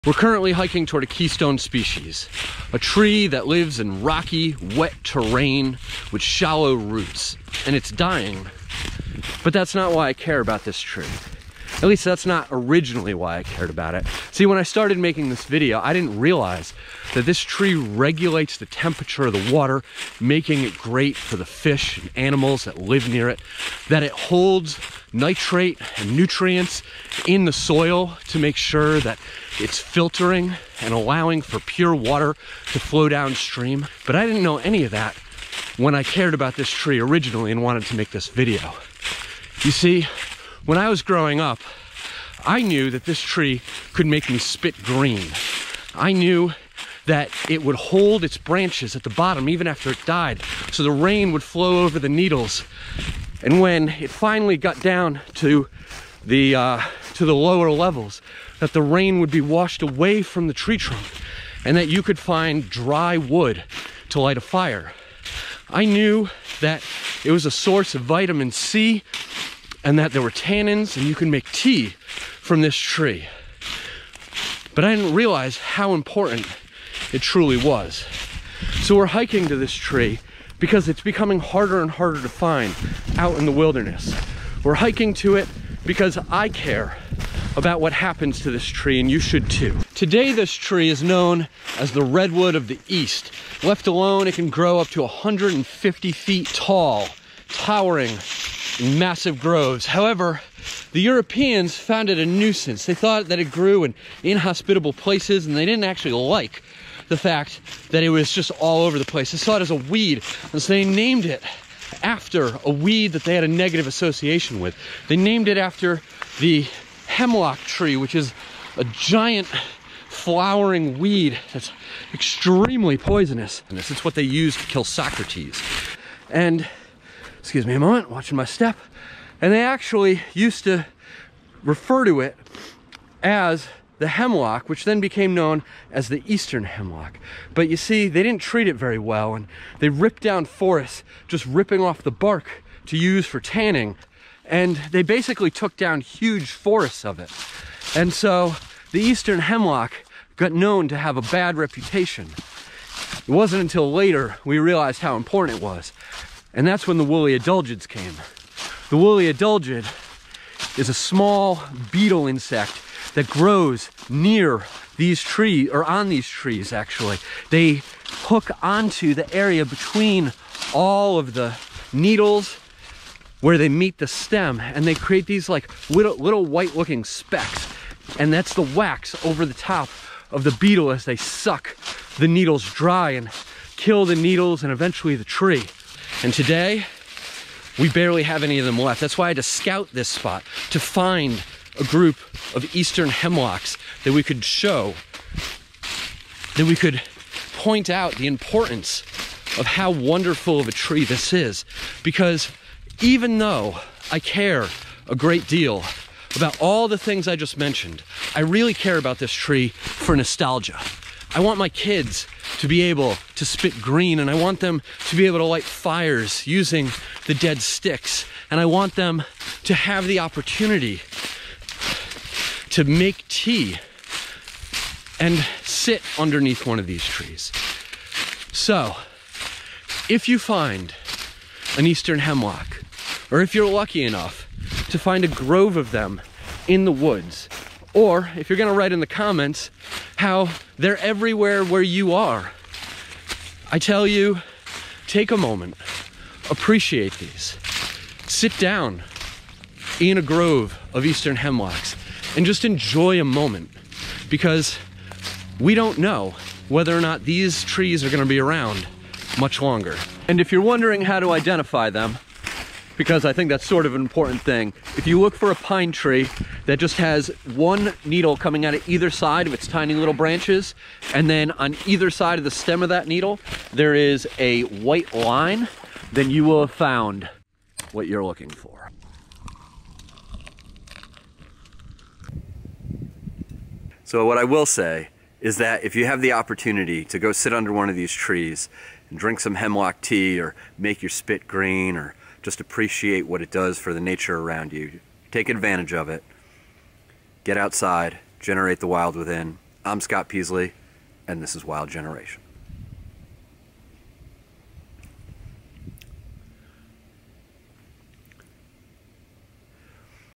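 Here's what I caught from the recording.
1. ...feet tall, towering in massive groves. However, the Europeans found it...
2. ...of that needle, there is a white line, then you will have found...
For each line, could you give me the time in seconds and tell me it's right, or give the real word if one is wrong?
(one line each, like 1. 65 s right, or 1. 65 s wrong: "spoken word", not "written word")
1. 96 s right
2. 272 s right.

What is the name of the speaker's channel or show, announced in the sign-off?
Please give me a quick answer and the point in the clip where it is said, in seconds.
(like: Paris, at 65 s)
Wild Generation, at 301 s.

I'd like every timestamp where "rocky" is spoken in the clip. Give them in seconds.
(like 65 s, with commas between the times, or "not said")
4 s.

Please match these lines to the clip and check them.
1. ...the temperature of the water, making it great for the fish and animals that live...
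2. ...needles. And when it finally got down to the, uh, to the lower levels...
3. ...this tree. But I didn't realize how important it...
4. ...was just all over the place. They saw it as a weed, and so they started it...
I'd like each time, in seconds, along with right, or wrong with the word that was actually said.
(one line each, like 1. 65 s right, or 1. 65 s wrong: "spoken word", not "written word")
1. 18 s right
2. 52 s right
3. 72 s right
4. 108 s wrong: "named", not "started".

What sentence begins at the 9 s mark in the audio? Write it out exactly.
But that's not why I care about this tree.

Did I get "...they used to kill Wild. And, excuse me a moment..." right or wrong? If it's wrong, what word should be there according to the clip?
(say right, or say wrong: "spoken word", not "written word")
wrong: "Socrates", not "Wild".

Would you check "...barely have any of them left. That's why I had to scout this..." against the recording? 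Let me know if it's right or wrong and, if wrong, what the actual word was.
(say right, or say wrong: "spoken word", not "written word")
right.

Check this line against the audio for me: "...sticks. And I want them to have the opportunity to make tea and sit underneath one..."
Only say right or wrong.
right.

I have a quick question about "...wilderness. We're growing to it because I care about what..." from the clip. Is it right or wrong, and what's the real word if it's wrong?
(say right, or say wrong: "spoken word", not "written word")
wrong: "hiking", not "growing".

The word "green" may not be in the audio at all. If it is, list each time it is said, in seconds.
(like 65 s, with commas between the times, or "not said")
44 s, 213 s, 291 s.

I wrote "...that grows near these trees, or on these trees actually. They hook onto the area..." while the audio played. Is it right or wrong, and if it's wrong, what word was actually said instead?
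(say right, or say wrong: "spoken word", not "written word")
right.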